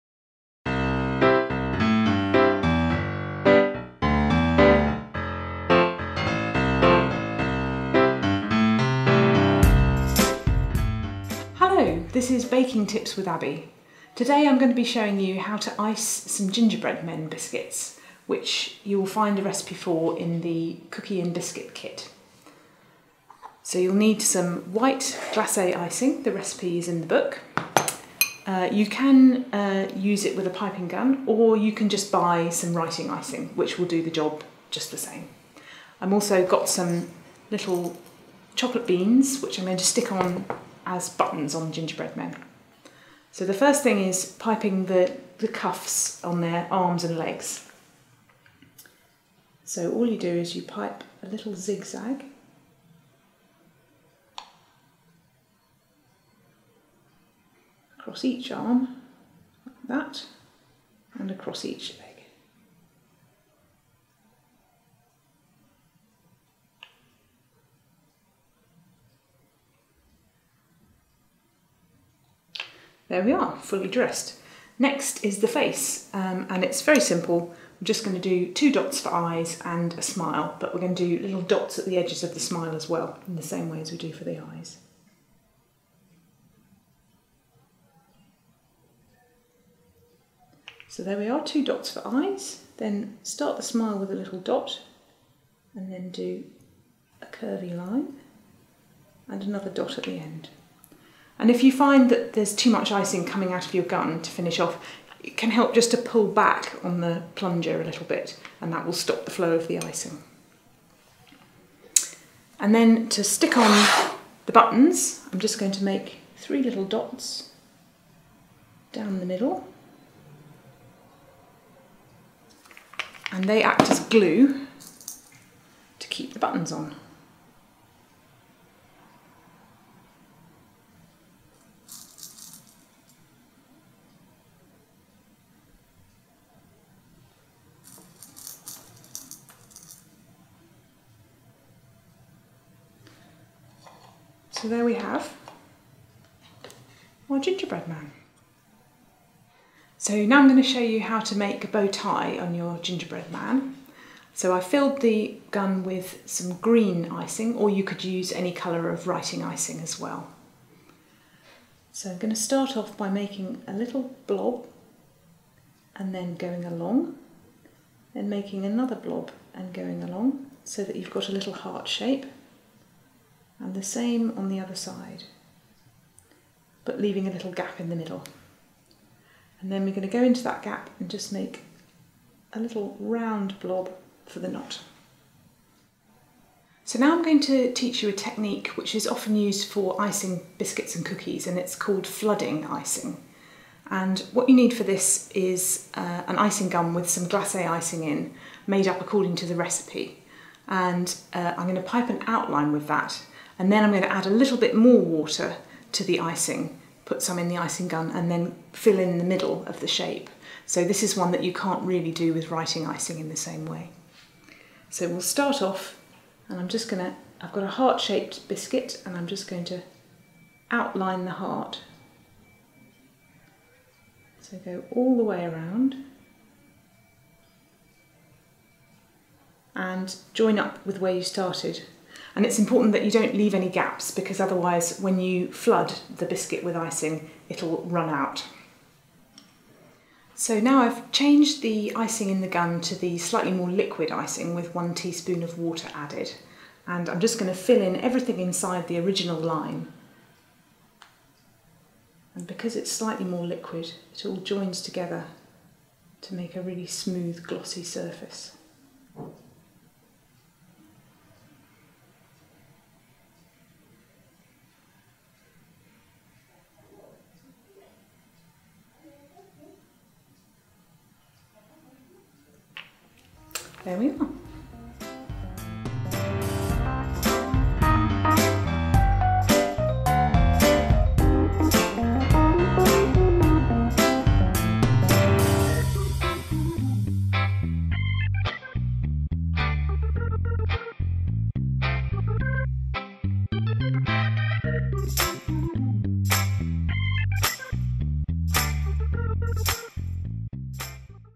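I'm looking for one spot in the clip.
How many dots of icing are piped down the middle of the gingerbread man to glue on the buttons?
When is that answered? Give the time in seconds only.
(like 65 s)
116 s.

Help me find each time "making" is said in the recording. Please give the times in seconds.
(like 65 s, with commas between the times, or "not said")
163 s, 168 s.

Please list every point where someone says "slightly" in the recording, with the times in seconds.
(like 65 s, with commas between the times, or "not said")
243 s, 252 s.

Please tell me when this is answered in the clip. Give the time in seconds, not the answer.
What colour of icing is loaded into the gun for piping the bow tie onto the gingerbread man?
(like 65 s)
156 s.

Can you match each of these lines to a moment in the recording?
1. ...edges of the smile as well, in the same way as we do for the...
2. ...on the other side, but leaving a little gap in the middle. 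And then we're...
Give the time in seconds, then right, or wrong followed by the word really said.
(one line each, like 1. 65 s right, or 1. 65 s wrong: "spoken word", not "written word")
1. 81 s right
2. 174 s right.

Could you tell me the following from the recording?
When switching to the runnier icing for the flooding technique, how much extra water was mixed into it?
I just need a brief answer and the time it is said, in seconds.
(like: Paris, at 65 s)
1 teaspoon, at 244 s.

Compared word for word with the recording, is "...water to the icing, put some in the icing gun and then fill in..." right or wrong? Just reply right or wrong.
right.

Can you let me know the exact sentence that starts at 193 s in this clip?
And what you need for this is uh, an icing gun with some glacé icing in, made up according to the recipe.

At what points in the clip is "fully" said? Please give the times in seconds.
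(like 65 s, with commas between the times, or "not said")
73 s.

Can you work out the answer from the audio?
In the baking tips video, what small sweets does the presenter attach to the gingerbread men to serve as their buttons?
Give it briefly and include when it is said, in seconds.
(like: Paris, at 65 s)
chocolate beans, at 38 s.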